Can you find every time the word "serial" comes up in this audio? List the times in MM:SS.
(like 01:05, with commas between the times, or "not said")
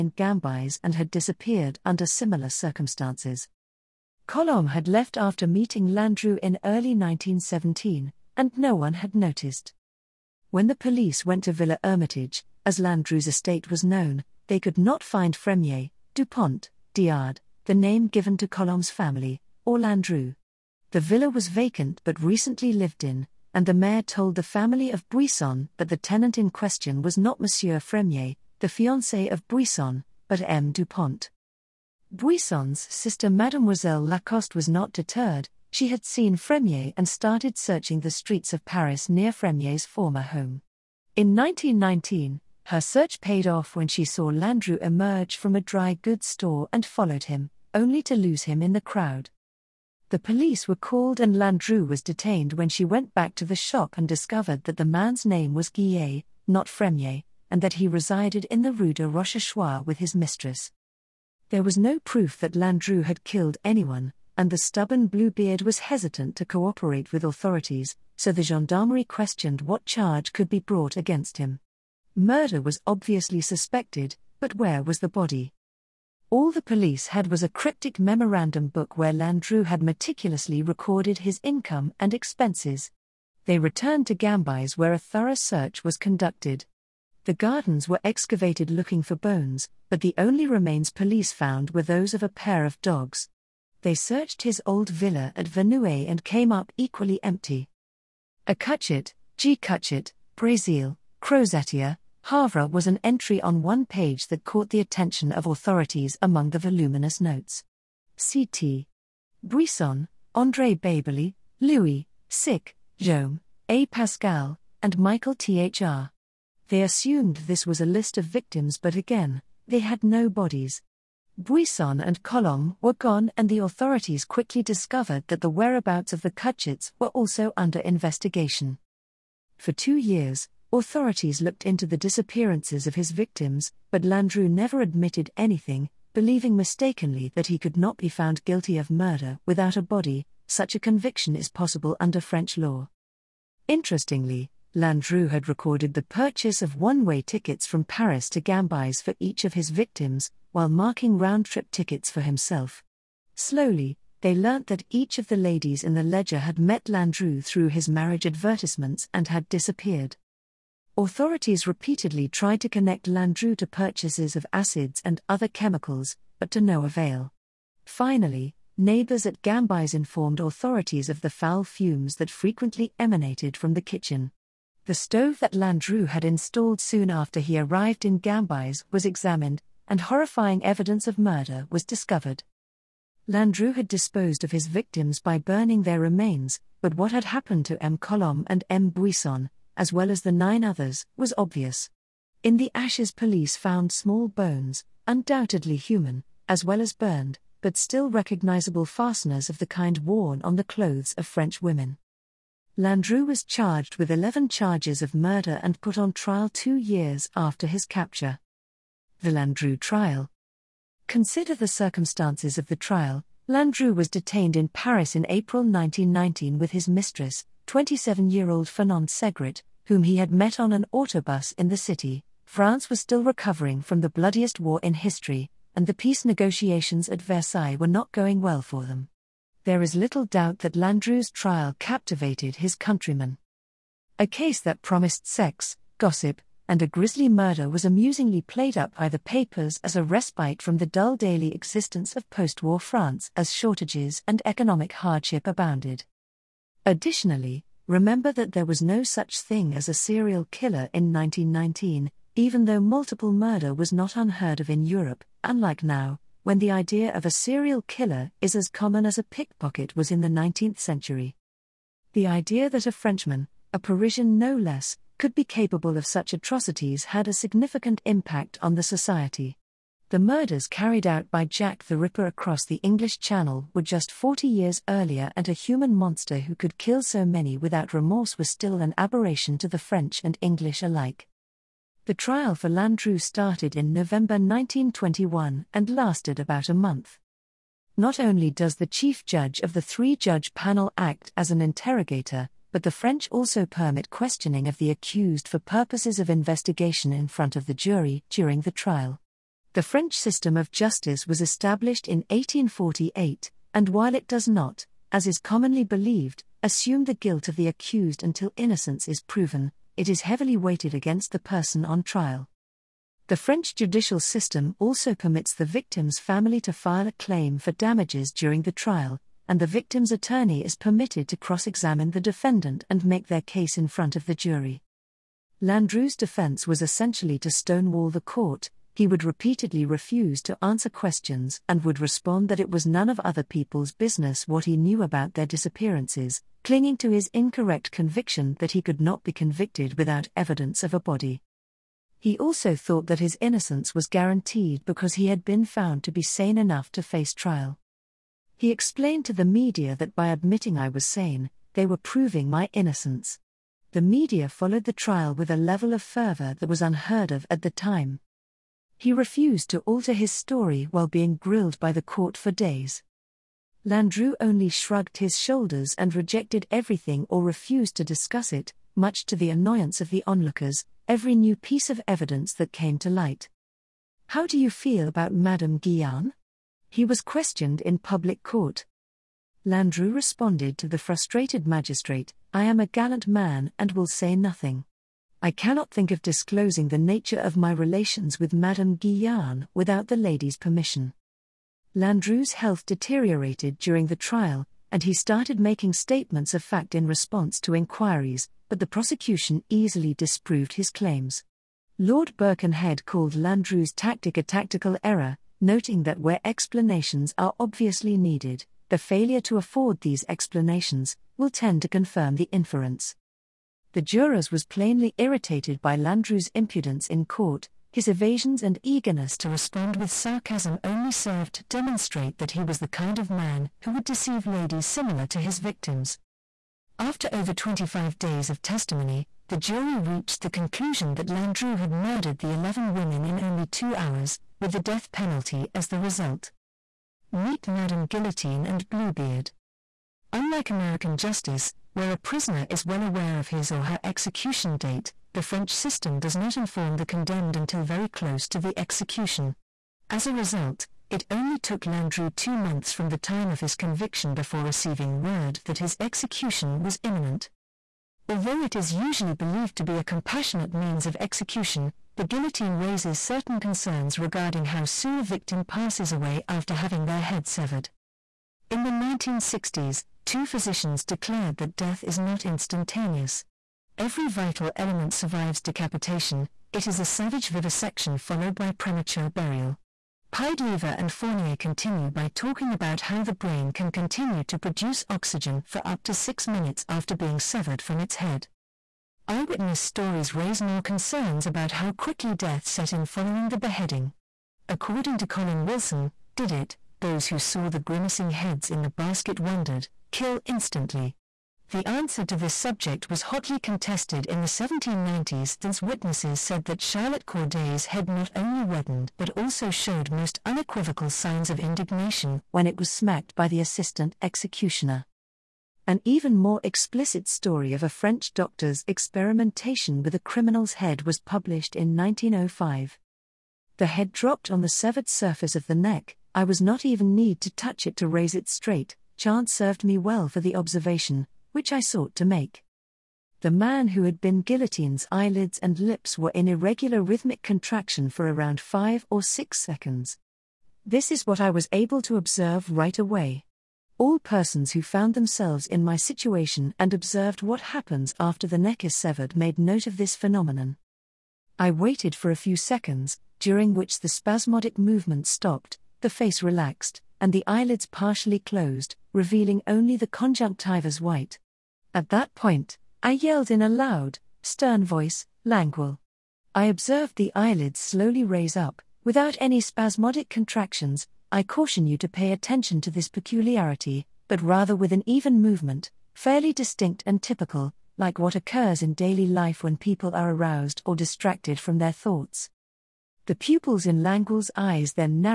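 04:09, 04:17.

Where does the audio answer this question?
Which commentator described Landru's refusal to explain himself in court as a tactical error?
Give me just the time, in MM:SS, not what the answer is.
06:41.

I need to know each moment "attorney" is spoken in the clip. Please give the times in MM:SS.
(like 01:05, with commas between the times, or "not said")
05:20.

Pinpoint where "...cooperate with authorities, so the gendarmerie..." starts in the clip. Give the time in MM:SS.
01:06.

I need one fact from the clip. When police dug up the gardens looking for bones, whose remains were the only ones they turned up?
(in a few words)
a pair of dogs.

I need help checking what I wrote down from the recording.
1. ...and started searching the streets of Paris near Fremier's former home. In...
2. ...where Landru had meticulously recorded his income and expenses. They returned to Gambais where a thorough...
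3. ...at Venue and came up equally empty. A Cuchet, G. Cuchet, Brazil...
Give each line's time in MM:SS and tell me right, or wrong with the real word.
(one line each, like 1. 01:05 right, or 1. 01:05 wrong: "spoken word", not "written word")
1. 00:36 right
2. 01:18 right
3. 01:35 right.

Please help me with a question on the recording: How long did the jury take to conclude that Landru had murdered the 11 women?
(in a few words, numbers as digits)
2 hours.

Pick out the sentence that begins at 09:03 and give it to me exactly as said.
All persons who found themselves in my situation and observed what happens after the neck is severed made note of this phenomenon.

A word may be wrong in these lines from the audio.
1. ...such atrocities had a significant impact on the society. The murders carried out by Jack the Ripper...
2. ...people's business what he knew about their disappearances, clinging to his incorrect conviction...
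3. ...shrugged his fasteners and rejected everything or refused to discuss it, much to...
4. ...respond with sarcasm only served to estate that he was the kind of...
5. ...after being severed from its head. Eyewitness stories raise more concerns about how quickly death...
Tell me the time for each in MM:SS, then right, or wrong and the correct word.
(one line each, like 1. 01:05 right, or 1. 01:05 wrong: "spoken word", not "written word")
1. 04:26 right
2. 05:33 right
3. 06:04 wrong: "shoulders", not "fasteners"
4. 06:59 wrong: "demonstrate", not "estate"
5. 08:06 right.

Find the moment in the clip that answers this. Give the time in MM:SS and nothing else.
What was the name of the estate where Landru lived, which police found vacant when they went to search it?
00:11.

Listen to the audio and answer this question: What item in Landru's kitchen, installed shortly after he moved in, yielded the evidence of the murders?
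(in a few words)
The stove.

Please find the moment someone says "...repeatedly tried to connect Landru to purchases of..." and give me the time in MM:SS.
02:41.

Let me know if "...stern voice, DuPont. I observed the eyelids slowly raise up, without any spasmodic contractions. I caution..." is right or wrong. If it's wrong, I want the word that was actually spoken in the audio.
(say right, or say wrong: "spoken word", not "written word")
wrong: "Languille", not "DuPont".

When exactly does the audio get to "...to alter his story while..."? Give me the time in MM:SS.
05:59.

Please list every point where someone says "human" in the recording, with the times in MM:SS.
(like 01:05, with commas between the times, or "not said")
03:15, 04:35.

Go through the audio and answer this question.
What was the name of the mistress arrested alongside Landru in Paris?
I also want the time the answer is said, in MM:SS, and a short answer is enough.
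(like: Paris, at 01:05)
Fernand Segret, at 03:38.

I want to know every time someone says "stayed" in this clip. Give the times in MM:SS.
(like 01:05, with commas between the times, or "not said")
not said.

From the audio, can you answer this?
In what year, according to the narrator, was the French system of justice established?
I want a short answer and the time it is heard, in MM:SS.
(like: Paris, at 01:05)
1848, at 05:02.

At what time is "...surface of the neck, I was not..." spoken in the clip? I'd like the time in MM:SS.
08:45.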